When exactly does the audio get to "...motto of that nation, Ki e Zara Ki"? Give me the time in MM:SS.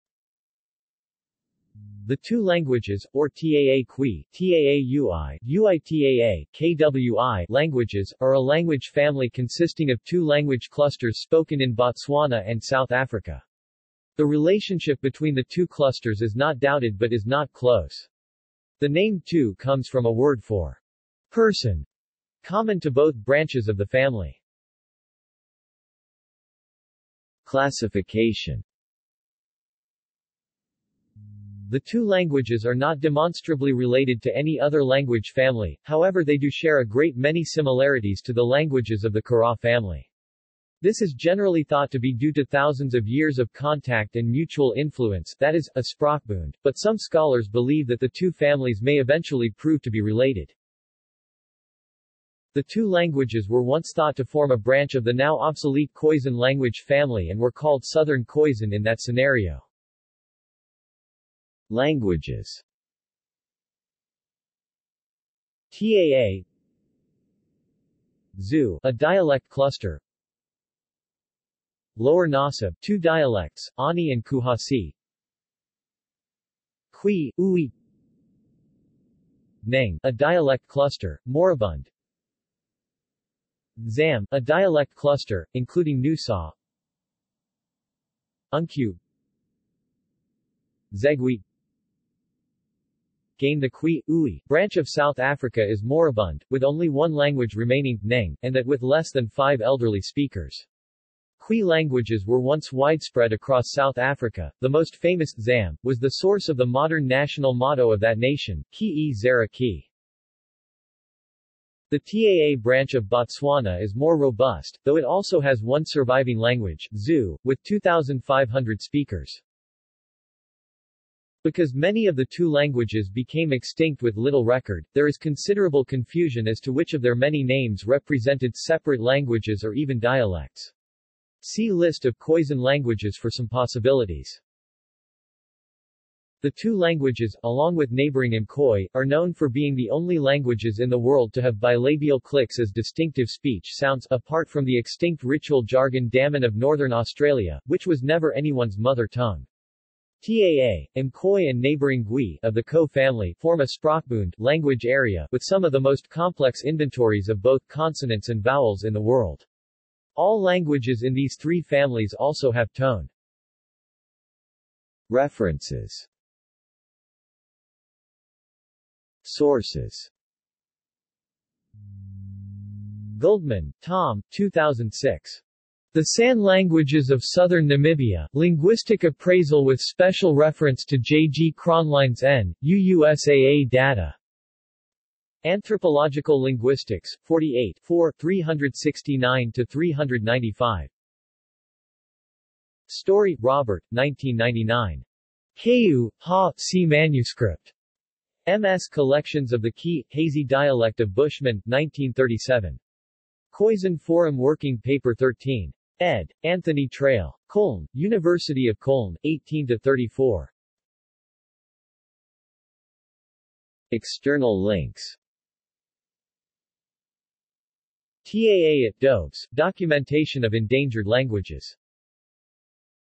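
01:47.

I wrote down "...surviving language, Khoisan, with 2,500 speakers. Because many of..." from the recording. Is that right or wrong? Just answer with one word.
wrong.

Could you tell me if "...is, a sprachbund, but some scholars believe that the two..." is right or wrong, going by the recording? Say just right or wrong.
right.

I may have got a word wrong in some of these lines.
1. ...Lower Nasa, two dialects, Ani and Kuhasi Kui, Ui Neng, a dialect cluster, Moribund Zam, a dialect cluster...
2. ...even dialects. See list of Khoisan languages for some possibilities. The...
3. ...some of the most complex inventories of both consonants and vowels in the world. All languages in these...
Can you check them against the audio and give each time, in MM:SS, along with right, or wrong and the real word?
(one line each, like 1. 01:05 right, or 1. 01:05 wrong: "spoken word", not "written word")
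1. 01:11 right
2. 02:09 right
3. 02:35 right.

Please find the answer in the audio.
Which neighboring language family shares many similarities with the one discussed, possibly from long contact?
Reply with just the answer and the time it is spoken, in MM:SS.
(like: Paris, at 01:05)
Kara, at 00:39.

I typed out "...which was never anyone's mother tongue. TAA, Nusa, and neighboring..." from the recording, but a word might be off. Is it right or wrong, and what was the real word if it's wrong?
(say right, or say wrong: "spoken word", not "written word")
wrong: "Mkoi", not "Nusa".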